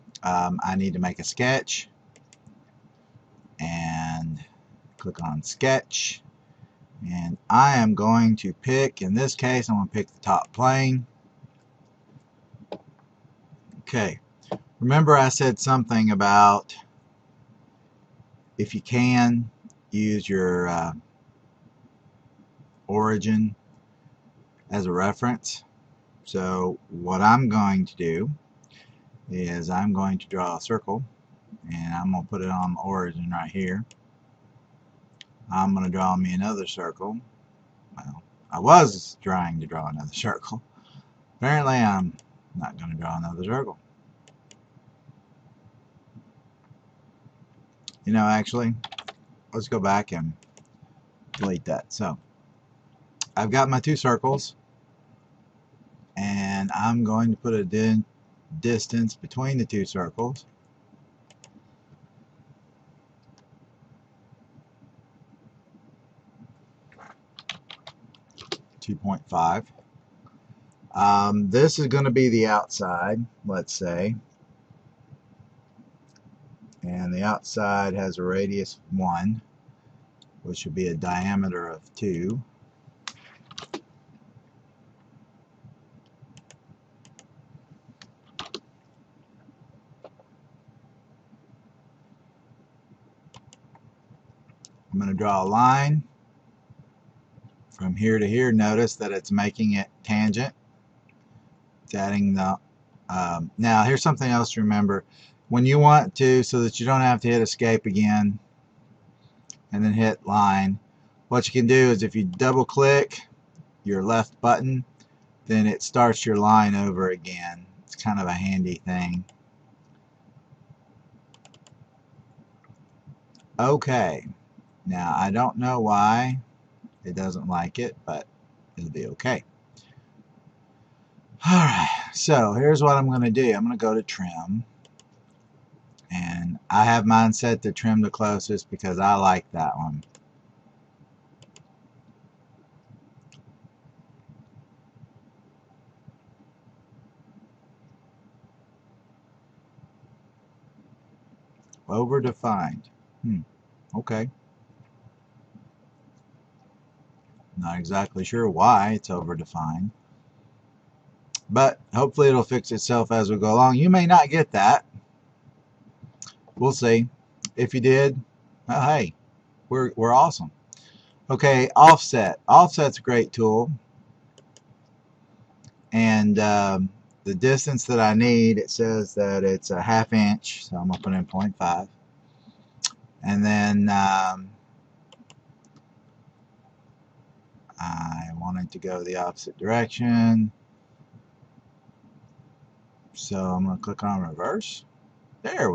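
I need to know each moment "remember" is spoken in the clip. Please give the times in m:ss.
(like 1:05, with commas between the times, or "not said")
0:14, 1:44.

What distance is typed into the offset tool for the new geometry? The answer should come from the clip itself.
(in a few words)
0.5.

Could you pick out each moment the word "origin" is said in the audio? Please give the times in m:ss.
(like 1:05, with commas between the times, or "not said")
0:22, 0:32.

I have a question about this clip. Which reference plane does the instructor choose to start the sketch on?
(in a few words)
Top plane.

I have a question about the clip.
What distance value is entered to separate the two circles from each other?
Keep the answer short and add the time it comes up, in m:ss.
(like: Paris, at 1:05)
2.5, at 1:08.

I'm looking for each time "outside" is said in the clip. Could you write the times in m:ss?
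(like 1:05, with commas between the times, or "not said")
1:12, 1:17.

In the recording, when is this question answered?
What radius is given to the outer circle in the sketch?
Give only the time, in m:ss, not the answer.
1:18.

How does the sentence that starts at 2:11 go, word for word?
Alright, so here's what I'm going to do.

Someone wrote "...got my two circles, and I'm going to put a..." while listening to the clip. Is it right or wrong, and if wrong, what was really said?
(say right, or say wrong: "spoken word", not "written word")
right.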